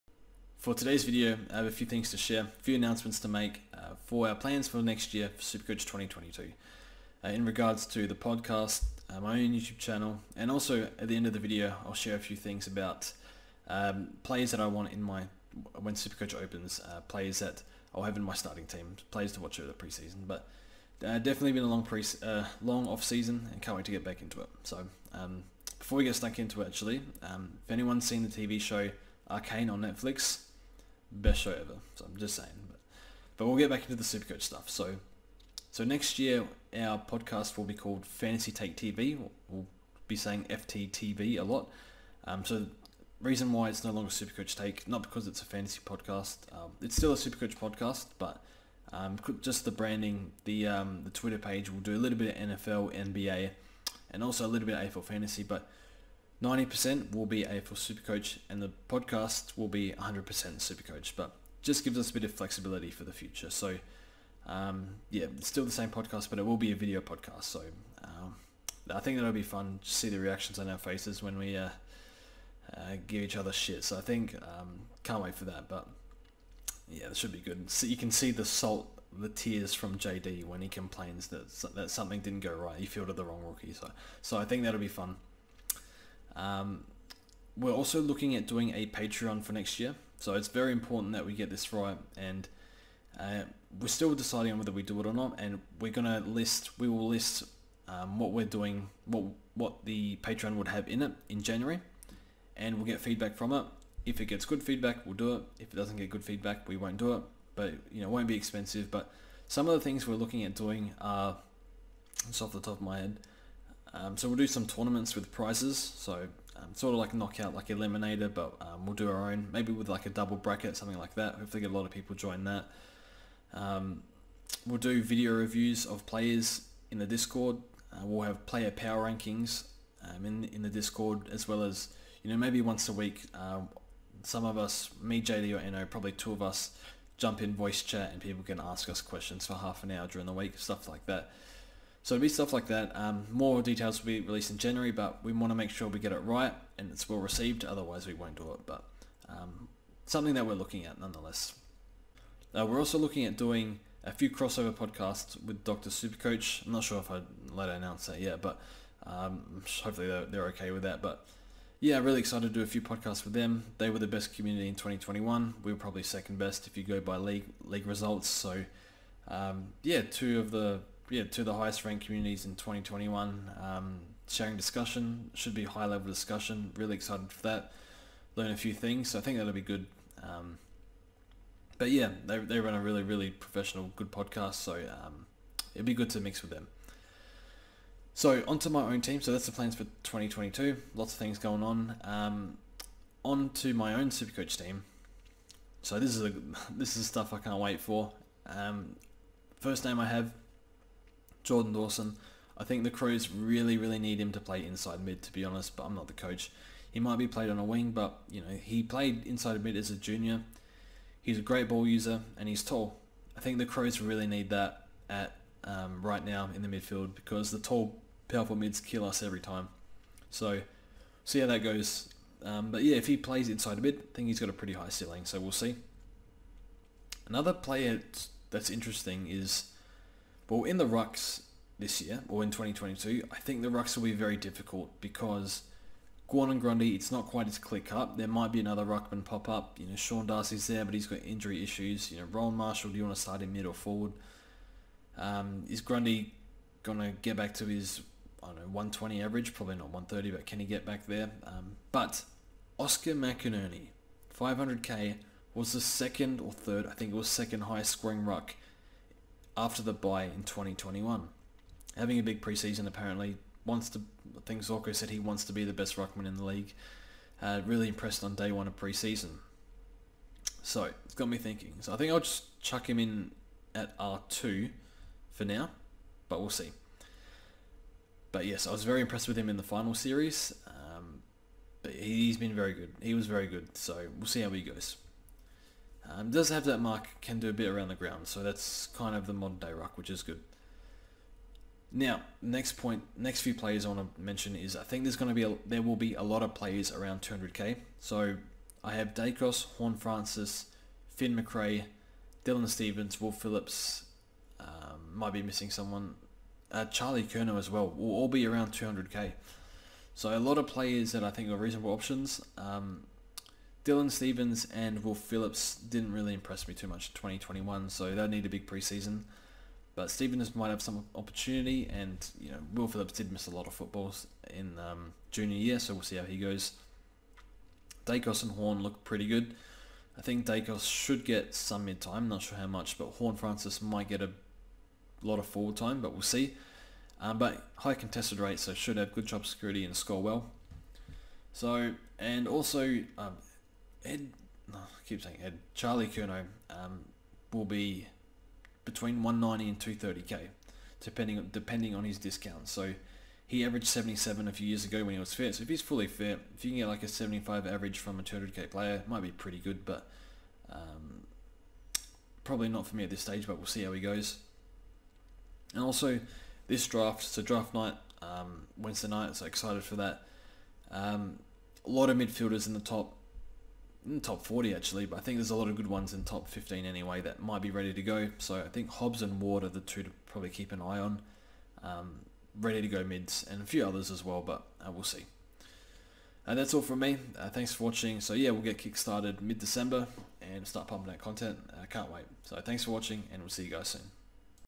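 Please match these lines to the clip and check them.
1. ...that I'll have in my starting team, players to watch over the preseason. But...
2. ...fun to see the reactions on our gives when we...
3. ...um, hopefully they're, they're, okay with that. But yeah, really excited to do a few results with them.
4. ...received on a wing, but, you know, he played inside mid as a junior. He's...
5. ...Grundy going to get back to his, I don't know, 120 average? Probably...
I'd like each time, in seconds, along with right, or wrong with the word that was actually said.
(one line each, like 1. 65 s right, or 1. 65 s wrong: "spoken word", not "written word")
1. 17 s right
2. 69 s wrong: "faces", not "gives"
3. 159 s wrong: "podcasts", not "results"
4. 207 s wrong: "played", not "received"
5. 245 s right.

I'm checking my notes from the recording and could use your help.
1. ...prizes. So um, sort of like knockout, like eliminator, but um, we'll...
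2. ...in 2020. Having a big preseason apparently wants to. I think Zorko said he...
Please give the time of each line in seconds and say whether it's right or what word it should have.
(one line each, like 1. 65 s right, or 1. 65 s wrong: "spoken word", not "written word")
1. 115 s right
2. 260 s wrong: "2021", not "2020".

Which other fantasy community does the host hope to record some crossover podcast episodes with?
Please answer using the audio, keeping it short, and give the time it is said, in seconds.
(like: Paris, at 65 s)
Dr. Supercoach, at 155 s.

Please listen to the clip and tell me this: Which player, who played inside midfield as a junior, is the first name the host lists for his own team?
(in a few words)
Jordan Dawson.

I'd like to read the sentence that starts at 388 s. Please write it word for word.
So yeah, we'll get kickstarted mid-December and start pumping out content.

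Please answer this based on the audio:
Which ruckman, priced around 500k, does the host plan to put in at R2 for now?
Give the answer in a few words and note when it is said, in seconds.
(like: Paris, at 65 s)
Oscar McInerney, at 252 s.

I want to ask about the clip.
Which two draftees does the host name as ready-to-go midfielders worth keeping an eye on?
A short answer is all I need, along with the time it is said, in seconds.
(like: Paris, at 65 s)
Hobbs and Ward, at 378 s.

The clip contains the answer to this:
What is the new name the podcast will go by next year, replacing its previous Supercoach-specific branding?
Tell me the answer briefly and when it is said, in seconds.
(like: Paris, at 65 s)
Fantasy Take TV, at 38 s.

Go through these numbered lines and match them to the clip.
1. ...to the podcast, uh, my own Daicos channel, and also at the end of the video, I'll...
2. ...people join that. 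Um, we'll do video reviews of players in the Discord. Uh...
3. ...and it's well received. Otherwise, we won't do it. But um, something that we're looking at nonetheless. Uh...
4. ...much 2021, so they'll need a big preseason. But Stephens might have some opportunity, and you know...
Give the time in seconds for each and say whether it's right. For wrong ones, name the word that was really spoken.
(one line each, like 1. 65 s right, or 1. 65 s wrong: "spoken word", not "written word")
1. 7 s wrong: "YouTube", not "Daicos"
2. 121 s right
3. 146 s right
4. 316 s right.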